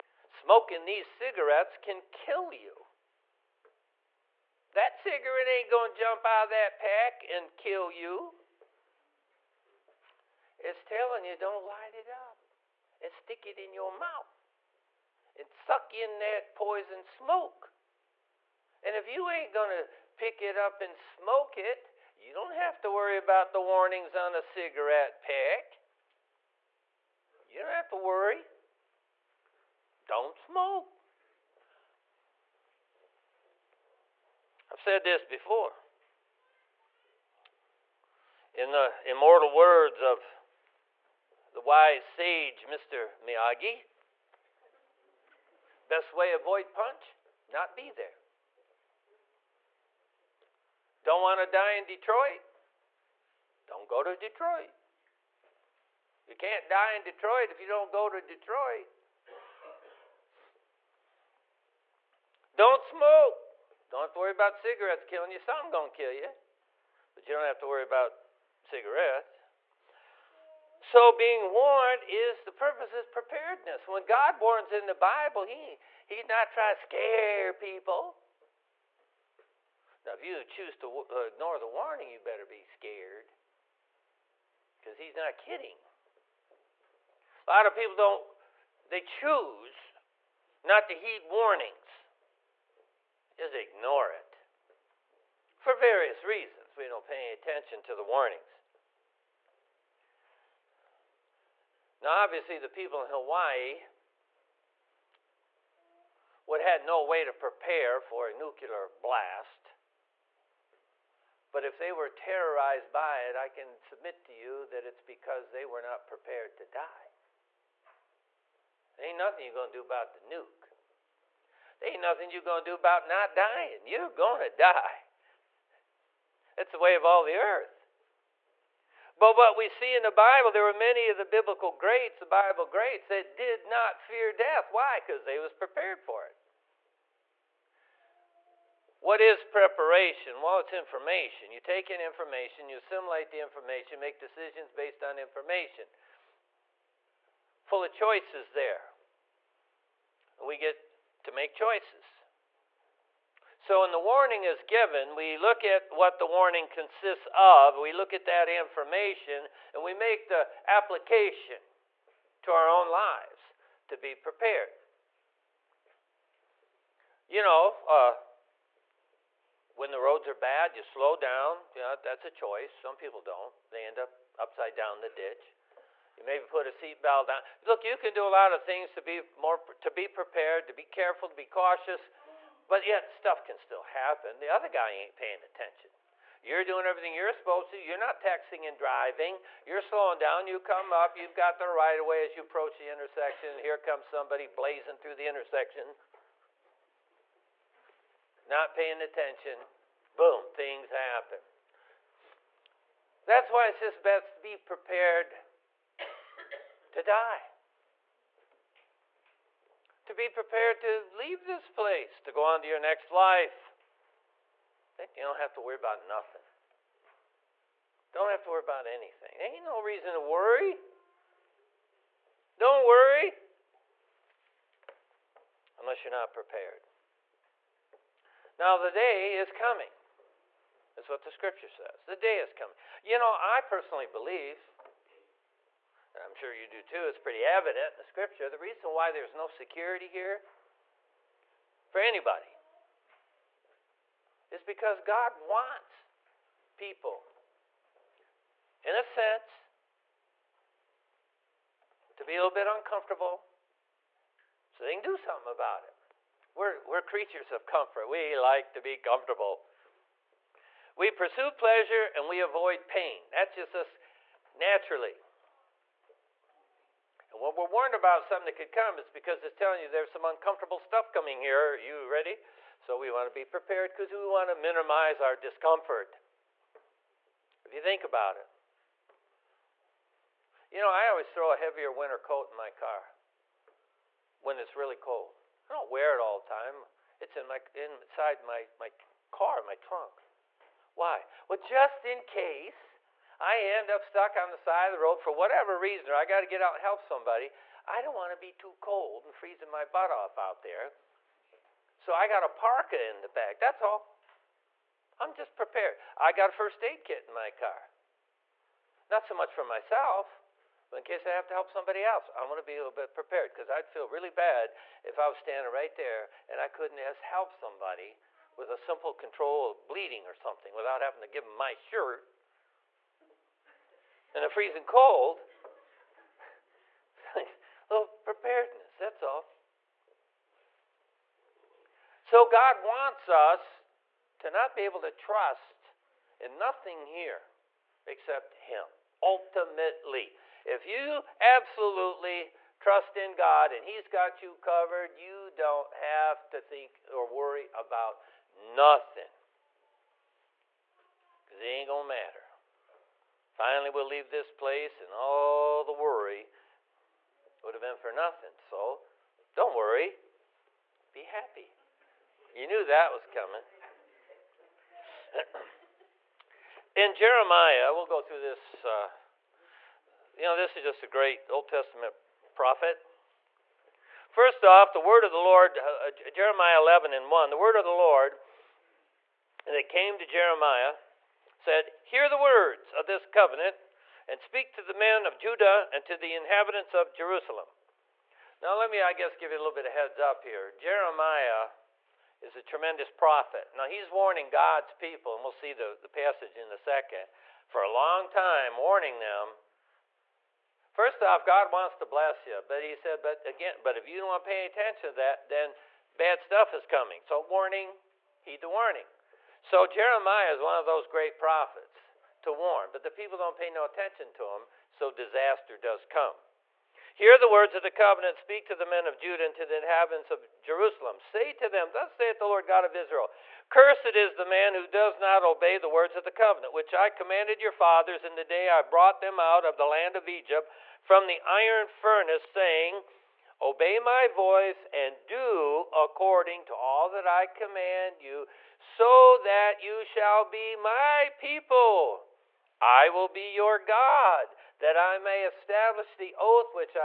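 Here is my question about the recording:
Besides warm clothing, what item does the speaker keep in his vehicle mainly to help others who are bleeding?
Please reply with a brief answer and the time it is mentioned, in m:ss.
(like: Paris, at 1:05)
First aid kit, at 5:06.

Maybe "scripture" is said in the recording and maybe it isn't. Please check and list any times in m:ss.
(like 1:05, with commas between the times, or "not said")
3:51, 3:58.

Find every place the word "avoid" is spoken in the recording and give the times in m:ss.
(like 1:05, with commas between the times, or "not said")
0:46, 4:22.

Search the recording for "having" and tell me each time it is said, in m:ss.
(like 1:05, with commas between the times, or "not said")
5:21.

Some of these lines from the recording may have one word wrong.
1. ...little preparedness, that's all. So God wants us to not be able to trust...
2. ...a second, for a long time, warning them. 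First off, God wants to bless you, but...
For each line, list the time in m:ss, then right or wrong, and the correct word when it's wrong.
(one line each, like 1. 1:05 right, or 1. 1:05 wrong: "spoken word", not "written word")
1. 5:27 right
2. 6:36 right.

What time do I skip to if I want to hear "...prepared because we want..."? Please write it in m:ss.
4:33.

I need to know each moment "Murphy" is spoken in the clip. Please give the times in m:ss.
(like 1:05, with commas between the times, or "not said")
not said.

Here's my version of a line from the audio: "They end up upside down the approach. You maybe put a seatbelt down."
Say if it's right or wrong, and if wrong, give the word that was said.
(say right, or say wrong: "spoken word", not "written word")
wrong: "ditch", not "approach".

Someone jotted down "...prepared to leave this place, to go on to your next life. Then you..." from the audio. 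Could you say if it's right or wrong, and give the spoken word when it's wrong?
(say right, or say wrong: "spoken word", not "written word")
right.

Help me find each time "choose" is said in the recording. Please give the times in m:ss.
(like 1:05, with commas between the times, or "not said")
1:20, 1:29.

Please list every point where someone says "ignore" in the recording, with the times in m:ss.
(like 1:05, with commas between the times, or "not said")
1:21, 1:33.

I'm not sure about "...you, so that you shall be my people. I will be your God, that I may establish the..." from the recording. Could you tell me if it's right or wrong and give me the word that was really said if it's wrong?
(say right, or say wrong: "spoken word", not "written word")
right.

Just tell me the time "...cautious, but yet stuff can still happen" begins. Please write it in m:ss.
3:01.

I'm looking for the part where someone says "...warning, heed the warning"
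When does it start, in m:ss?
6:47.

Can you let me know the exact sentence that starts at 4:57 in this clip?
I don't want to be too cold and freezing my butt off out there.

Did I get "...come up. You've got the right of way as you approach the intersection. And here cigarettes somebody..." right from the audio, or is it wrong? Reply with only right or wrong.
wrong.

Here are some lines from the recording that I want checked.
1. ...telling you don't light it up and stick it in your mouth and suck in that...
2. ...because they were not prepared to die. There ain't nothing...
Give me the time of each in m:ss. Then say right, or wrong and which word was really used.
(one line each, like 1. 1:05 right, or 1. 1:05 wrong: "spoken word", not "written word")
1. 0:10 right
2. 1:55 right.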